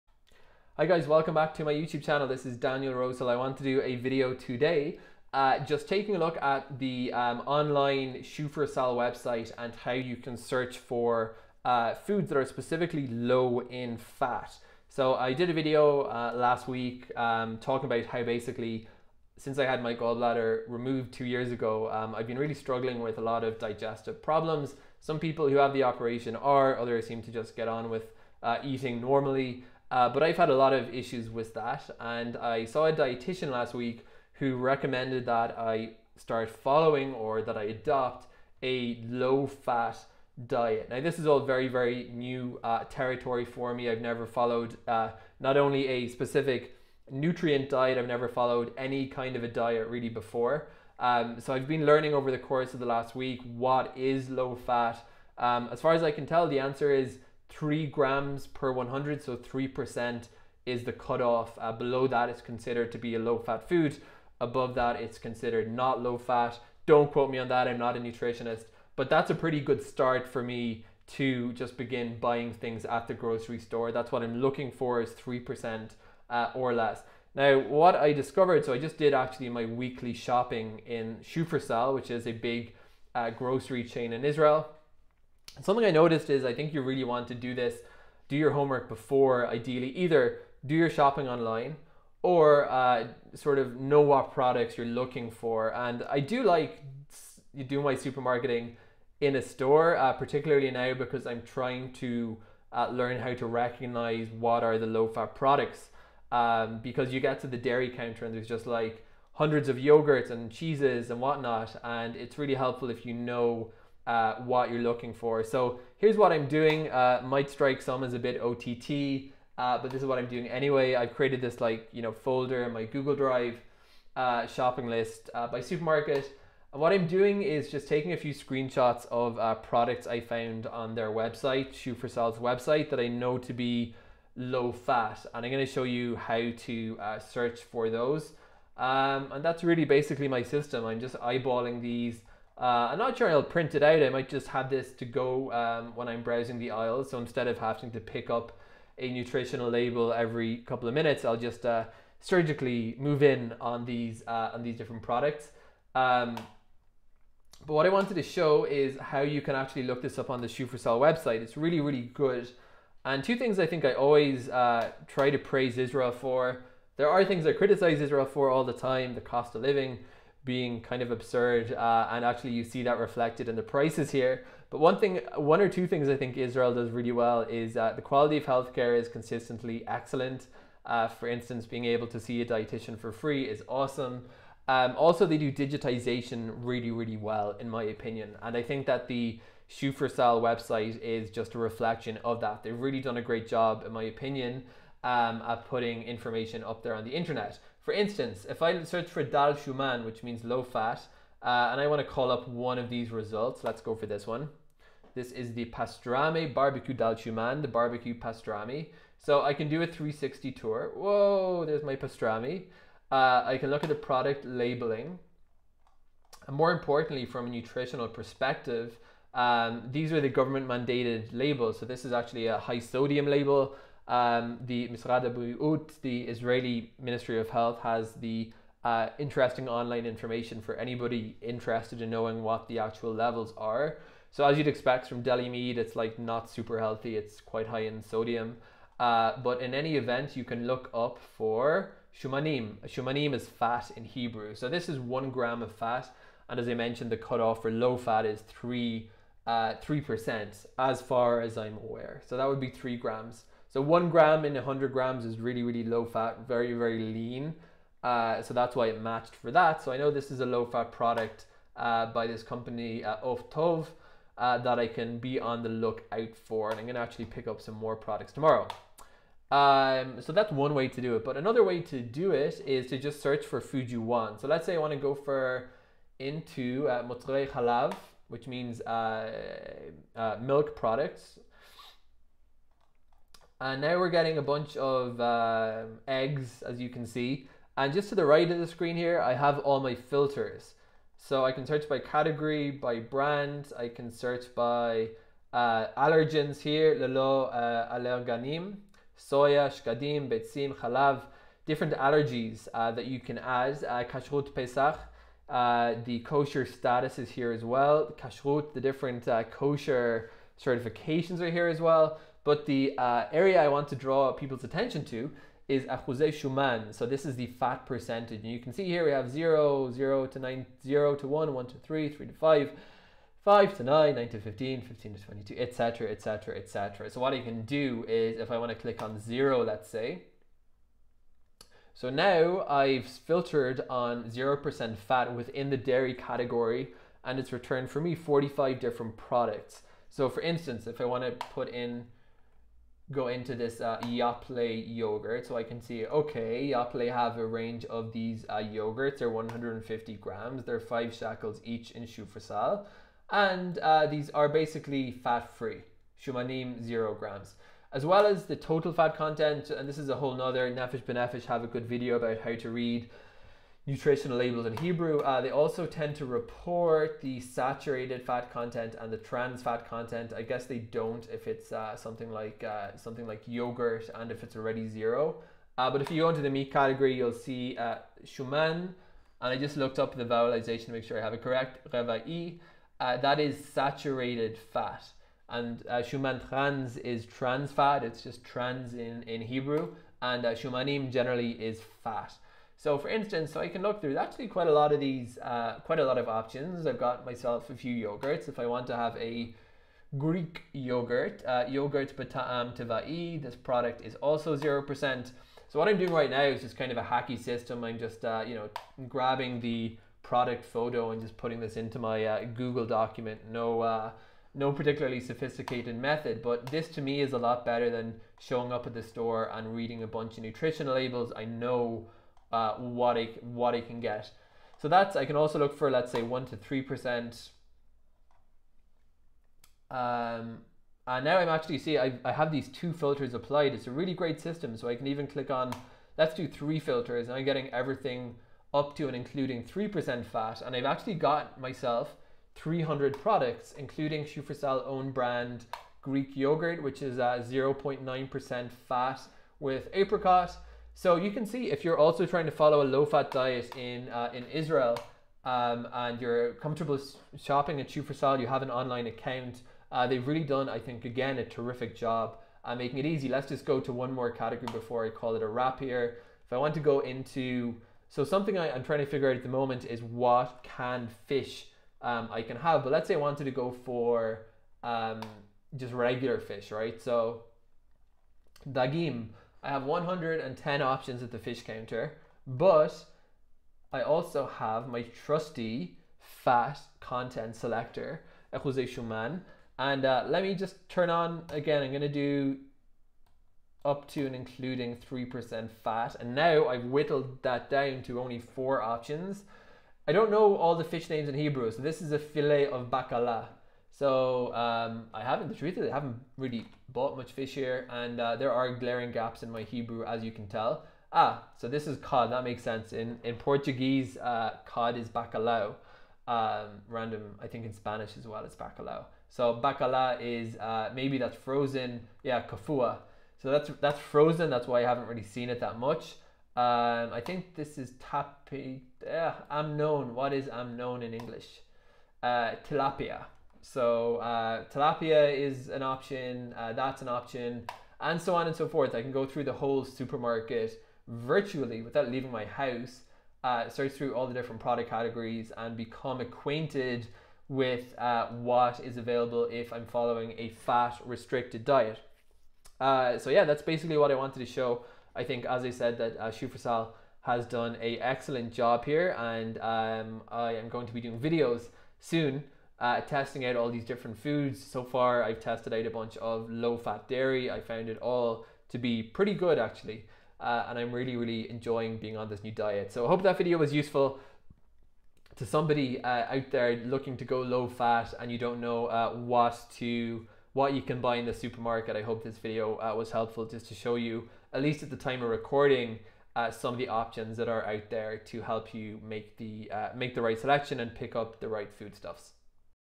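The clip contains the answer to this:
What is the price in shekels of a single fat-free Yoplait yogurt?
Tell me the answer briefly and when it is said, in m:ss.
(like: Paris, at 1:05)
5 shekels, at 5:50.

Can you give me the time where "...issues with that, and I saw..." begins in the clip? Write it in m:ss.
0:30.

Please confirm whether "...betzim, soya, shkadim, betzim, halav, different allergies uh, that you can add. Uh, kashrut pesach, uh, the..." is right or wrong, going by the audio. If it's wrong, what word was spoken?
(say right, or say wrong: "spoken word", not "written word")
wrong: "allerganim", not "betzim".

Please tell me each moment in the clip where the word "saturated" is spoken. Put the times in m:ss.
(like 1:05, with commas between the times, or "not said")
6:07, 6:23.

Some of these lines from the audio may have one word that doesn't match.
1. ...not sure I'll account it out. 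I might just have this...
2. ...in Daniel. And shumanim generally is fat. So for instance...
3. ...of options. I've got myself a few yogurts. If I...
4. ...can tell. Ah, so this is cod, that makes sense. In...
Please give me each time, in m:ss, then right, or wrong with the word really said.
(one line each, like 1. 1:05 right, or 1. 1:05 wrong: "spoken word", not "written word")
1. 2:22 wrong: "print", not "account"
2. 6:29 wrong: "Hebrew", not "Daniel"
3. 6:36 right
4. 8:30 right.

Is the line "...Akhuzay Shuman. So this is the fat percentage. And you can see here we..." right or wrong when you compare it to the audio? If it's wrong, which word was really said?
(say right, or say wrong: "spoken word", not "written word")
right.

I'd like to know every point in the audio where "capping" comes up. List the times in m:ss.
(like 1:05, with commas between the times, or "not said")
not said.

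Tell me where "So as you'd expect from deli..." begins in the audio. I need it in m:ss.
3:54.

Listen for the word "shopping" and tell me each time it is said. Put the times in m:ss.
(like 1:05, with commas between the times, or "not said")
1:20, 1:30, 2:04, 7:37.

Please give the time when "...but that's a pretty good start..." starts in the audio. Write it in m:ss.
1:08.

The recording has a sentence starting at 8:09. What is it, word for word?
And uh, let me just turn on again, I'm gonna do up to and including 3% fat.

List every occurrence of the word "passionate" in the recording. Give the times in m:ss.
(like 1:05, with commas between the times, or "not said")
not said.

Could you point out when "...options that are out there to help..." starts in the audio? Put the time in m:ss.
9:46.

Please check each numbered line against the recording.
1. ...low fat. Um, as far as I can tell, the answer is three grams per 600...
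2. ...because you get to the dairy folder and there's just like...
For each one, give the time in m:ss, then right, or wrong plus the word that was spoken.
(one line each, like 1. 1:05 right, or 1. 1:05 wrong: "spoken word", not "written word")
1. 0:54 wrong: "100", not "600"
2. 1:46 wrong: "counter", not "folder".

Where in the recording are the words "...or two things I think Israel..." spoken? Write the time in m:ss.
2:55.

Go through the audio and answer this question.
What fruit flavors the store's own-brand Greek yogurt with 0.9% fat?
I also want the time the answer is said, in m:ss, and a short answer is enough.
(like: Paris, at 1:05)
apricot, at 7:29.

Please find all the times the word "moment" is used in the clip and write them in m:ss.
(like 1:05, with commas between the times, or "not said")
7:49.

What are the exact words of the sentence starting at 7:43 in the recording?
Let's just go to one more category before I call it a wrap here.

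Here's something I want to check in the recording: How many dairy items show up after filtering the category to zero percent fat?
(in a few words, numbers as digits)
45.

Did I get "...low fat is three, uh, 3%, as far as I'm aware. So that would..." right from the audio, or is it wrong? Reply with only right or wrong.
right.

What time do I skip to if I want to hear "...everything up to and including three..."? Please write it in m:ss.
7:17.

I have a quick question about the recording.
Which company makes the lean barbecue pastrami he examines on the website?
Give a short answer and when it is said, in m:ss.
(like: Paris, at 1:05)
Oftov, at 4:23.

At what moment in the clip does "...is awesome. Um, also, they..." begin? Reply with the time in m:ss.
3:03.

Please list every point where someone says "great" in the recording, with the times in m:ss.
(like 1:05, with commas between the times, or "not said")
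3:13, 7:14.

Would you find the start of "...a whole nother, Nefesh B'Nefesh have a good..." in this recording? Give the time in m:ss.
6:00.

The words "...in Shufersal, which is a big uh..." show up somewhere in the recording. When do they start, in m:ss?
1:20.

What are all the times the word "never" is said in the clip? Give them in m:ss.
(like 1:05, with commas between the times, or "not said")
0:43, 0:48.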